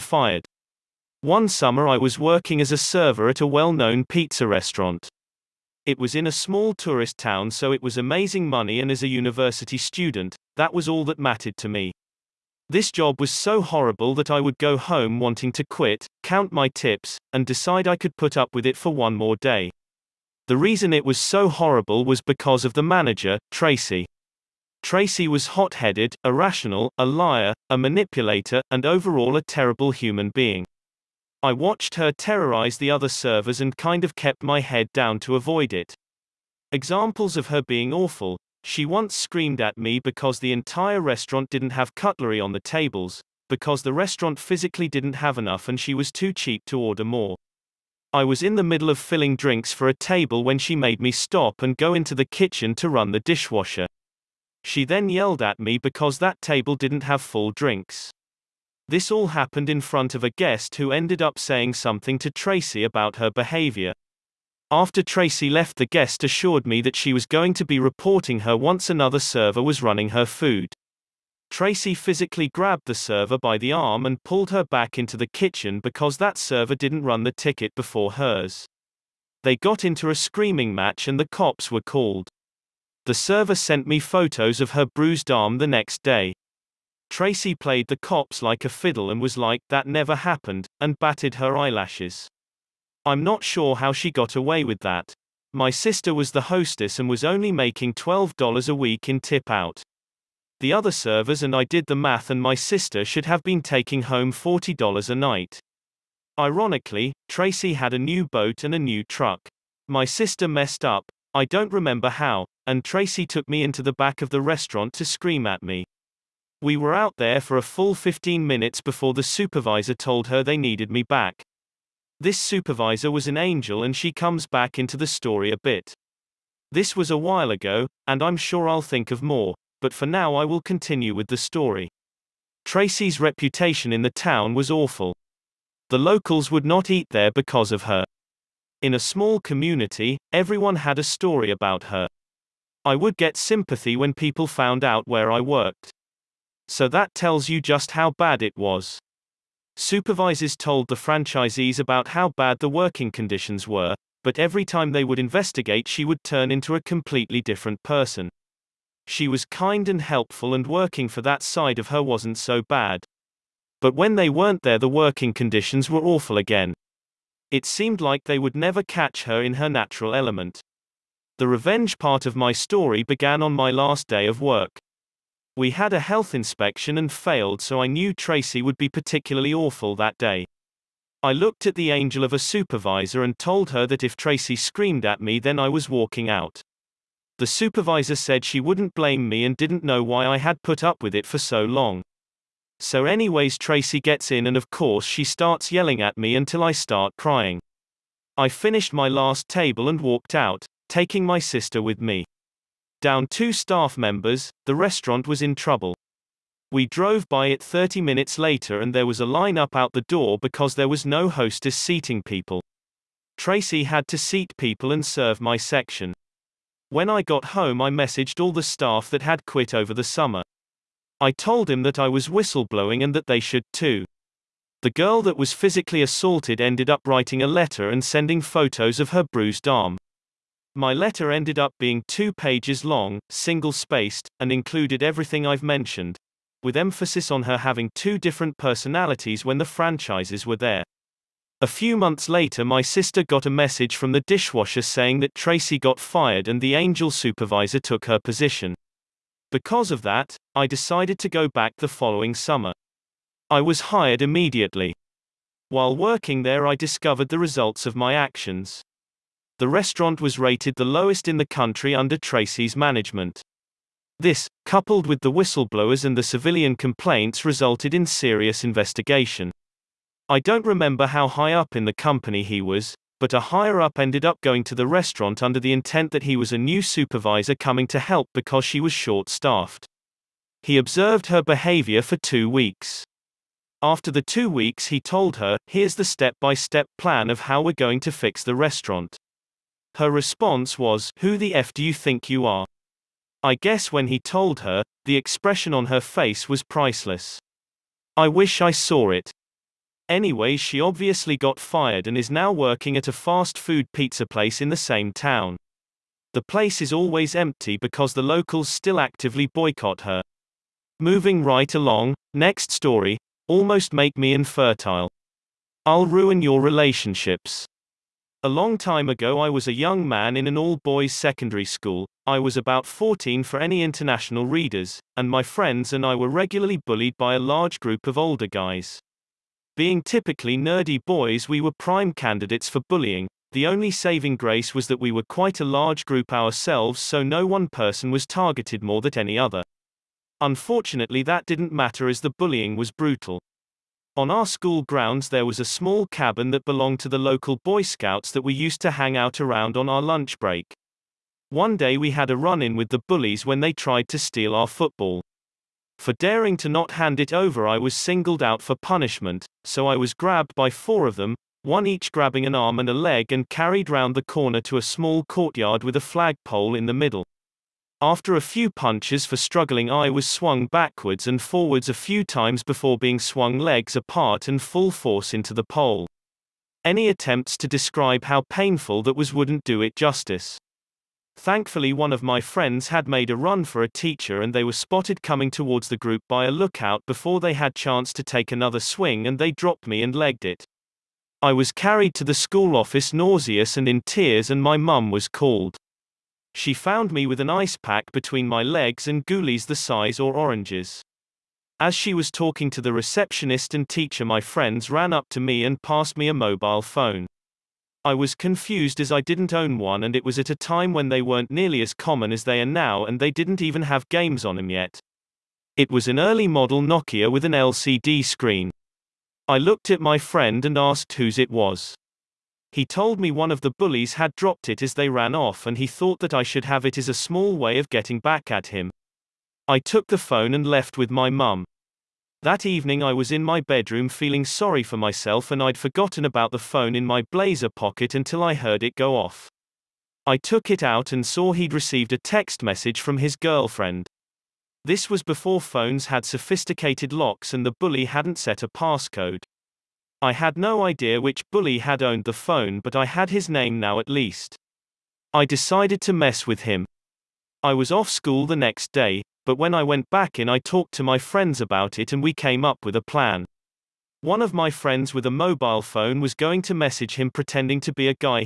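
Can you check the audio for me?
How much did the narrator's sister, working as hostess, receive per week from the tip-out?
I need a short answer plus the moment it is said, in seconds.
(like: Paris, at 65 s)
$12, at 97 s.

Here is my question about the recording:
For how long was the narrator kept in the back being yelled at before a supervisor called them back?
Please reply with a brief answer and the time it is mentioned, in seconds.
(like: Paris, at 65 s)
15 minutes, at 117 s.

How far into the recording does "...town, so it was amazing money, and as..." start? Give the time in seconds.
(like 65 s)
7 s.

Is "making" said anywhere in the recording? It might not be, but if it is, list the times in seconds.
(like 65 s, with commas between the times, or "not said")
97 s.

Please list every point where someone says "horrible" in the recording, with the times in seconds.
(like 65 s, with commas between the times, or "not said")
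13 s, 21 s.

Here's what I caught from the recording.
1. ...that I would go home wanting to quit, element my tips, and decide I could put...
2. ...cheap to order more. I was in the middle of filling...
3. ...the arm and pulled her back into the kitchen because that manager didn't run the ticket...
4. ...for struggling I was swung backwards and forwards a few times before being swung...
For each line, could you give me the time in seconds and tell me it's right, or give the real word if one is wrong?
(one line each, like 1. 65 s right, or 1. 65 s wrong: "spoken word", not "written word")
1. 14 s wrong: "count", not "element"
2. 46 s right
3. 73 s wrong: "server", not "manager"
4. 369 s right.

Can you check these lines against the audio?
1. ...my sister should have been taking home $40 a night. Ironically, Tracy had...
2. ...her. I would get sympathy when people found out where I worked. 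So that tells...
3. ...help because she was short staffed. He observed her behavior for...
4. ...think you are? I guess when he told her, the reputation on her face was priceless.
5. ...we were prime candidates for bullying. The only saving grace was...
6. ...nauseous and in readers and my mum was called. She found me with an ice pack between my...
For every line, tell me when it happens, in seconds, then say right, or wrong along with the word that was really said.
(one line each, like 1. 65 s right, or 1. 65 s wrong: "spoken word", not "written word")
1. 102 s right
2. 141 s right
3. 277 s right
4. 291 s wrong: "expression", not "reputation"
5. 331 s right
6. 393 s wrong: "tears", not "readers".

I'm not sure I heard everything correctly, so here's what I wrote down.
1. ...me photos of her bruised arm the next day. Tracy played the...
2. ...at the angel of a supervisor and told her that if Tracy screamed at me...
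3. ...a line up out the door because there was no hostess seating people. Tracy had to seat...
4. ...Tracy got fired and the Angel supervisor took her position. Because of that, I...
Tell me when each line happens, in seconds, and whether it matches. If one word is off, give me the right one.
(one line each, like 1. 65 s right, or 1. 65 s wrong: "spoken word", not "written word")
1. 83 s right
2. 181 s right
3. 209 s right
4. 245 s right.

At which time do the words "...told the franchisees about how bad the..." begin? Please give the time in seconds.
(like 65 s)
150 s.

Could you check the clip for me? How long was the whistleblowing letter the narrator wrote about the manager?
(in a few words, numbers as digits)
two pages.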